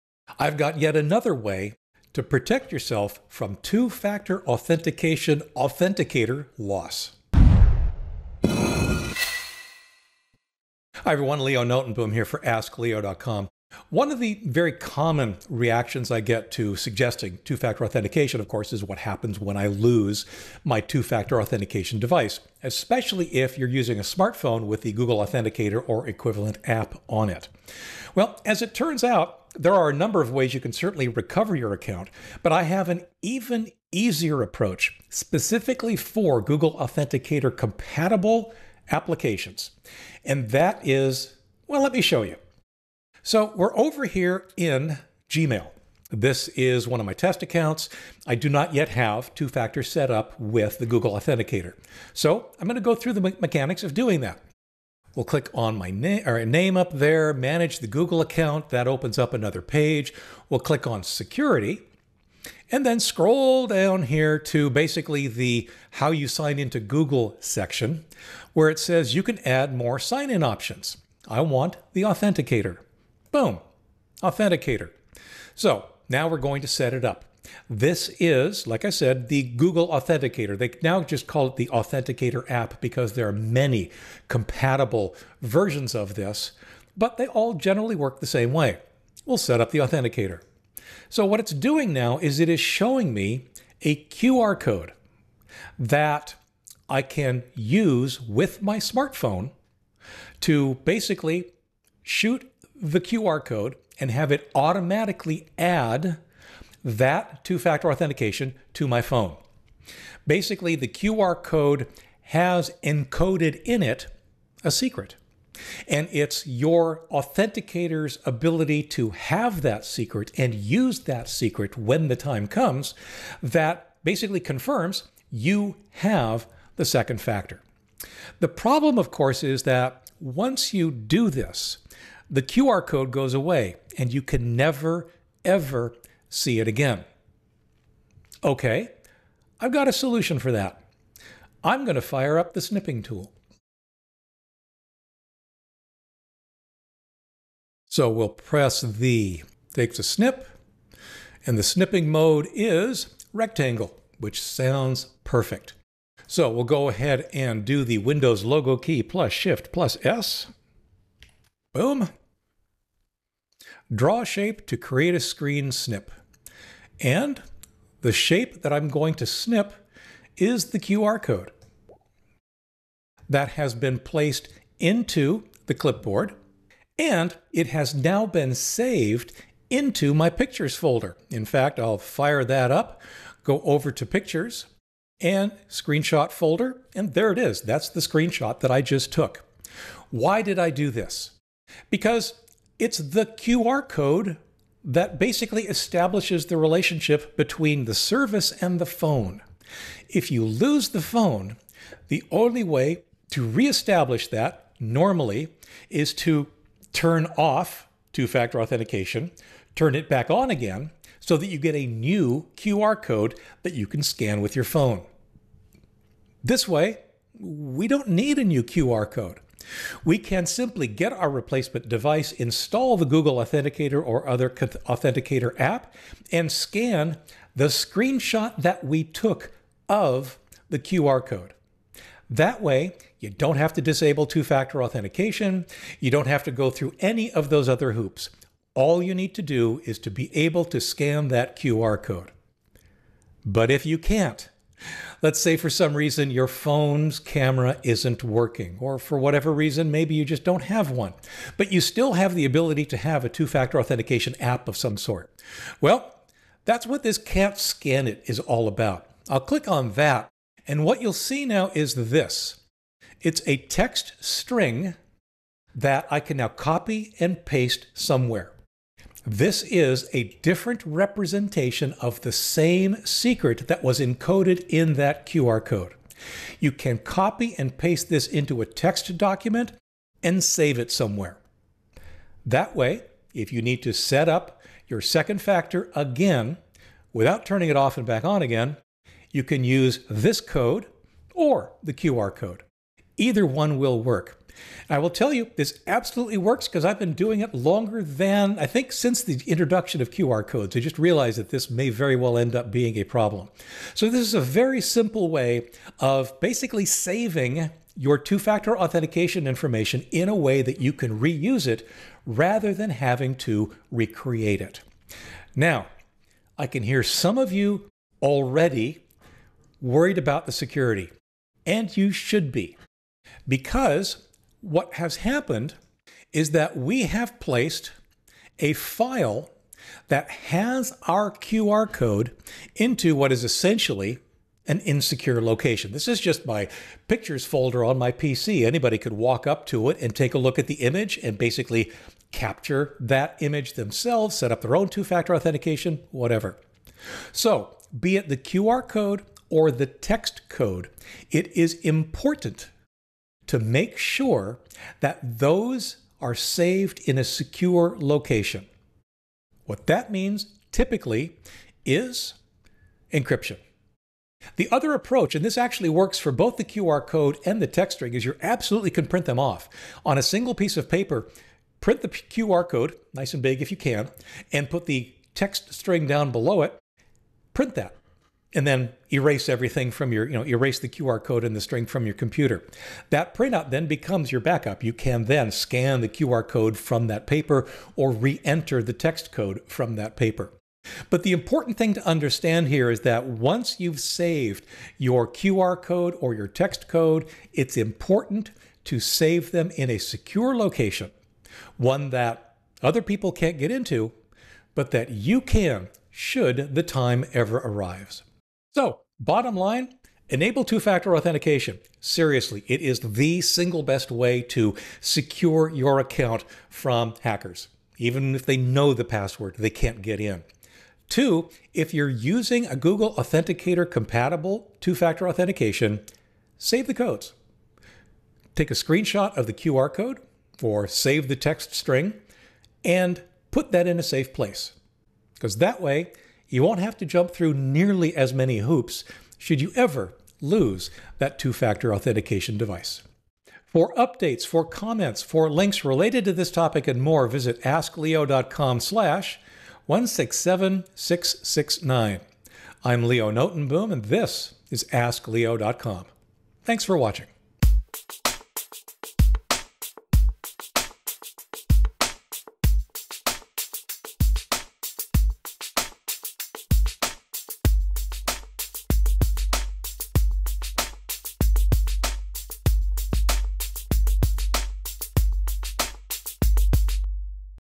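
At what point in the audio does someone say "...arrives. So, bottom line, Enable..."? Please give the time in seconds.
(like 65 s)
407 s.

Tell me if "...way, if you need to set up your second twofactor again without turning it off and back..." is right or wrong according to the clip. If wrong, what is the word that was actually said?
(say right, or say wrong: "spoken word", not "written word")
wrong: "factor", not "twofactor".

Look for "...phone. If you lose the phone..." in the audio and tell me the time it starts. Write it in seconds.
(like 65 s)
198 s.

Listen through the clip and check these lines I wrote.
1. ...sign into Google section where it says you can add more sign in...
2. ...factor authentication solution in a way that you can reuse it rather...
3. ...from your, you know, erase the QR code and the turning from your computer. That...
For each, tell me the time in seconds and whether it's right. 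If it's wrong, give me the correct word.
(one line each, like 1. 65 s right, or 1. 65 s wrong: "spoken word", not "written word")
1. 66 s right
2. 308 s wrong: "information", not "solution"
3. 379 s wrong: "string", not "turning".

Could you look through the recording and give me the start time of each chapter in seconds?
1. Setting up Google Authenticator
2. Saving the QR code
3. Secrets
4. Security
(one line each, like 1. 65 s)
1. 55 s
2. 180 s
3. 240 s
4. 300 s.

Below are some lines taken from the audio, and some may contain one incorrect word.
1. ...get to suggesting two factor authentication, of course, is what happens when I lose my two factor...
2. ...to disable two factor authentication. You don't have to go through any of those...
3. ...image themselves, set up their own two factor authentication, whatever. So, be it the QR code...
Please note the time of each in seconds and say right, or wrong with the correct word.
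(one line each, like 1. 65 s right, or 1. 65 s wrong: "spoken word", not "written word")
1. 16 s right
2. 233 s right
3. 343 s right.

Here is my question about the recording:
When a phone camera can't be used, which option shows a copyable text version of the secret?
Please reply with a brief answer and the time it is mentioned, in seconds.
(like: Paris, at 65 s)
Can't scan it, at 257 s.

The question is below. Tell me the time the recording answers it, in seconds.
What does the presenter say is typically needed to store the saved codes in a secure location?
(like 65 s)
363 s.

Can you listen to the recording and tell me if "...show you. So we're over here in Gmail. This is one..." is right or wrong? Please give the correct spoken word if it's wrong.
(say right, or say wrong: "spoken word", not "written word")
right.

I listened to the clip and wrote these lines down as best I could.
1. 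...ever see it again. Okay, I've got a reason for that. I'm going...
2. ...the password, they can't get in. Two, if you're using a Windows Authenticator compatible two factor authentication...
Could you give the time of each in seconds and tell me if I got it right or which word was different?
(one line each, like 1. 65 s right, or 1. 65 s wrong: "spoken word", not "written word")
1. 135 s wrong: "solution", not "reason"
2. 418 s wrong: "Google", not "Windows".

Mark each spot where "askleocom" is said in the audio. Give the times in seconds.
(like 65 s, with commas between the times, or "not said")
12 s, 447 s, 454 s.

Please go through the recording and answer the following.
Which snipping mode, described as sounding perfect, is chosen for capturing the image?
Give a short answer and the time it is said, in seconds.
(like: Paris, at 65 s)
Rectangle, at 153 s.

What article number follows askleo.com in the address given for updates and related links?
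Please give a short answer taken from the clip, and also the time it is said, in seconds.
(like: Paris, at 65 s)
167669, at 449 s.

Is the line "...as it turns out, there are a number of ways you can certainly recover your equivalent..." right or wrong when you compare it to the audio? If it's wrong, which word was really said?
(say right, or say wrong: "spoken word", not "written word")
wrong: "account", not "equivalent".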